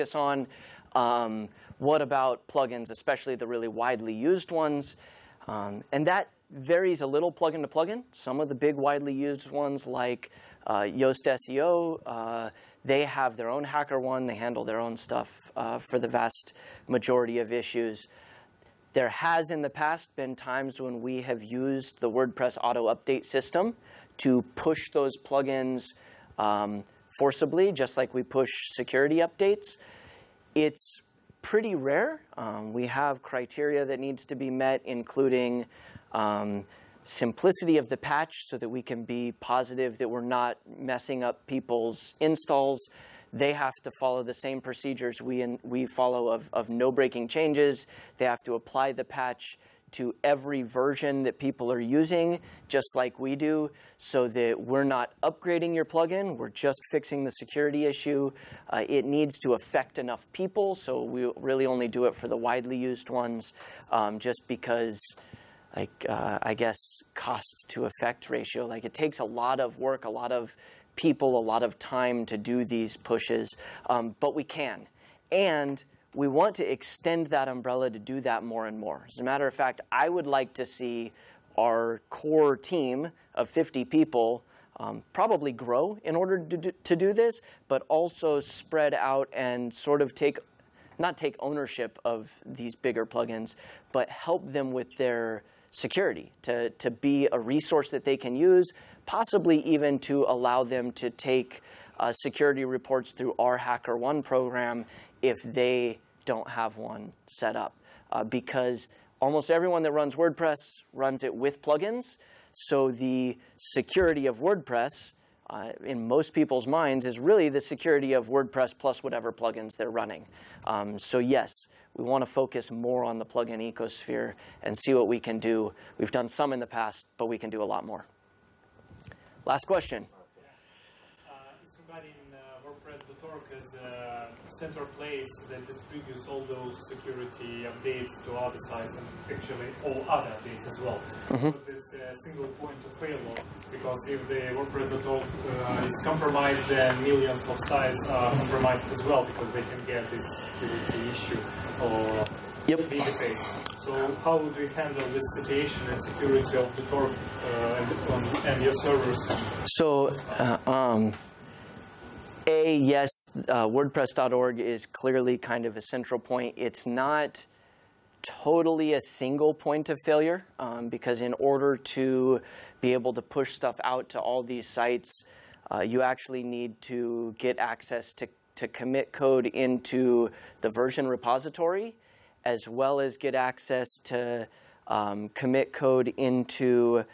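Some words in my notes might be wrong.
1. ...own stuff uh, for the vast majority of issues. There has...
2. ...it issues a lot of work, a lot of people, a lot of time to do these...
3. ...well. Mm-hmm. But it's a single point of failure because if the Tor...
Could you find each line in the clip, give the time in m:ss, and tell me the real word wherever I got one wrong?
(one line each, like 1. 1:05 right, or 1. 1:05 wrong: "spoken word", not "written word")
1. 0:14 right
2. 1:08 wrong: "takes", not "issues"
3. 2:20 wrong: "WordPress", not "Tor".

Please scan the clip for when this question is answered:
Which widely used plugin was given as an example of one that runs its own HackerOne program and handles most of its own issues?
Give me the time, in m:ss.
0:10.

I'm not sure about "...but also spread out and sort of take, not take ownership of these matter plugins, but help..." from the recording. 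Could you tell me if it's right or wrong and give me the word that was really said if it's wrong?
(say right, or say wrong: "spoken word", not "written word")
wrong: "bigger", not "matter".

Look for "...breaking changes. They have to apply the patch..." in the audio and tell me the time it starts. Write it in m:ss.
0:46.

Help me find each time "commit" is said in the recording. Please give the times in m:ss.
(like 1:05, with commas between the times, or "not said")
2:58, 3:05.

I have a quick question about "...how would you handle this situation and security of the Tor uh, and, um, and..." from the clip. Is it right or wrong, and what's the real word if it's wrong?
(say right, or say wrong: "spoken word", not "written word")
right.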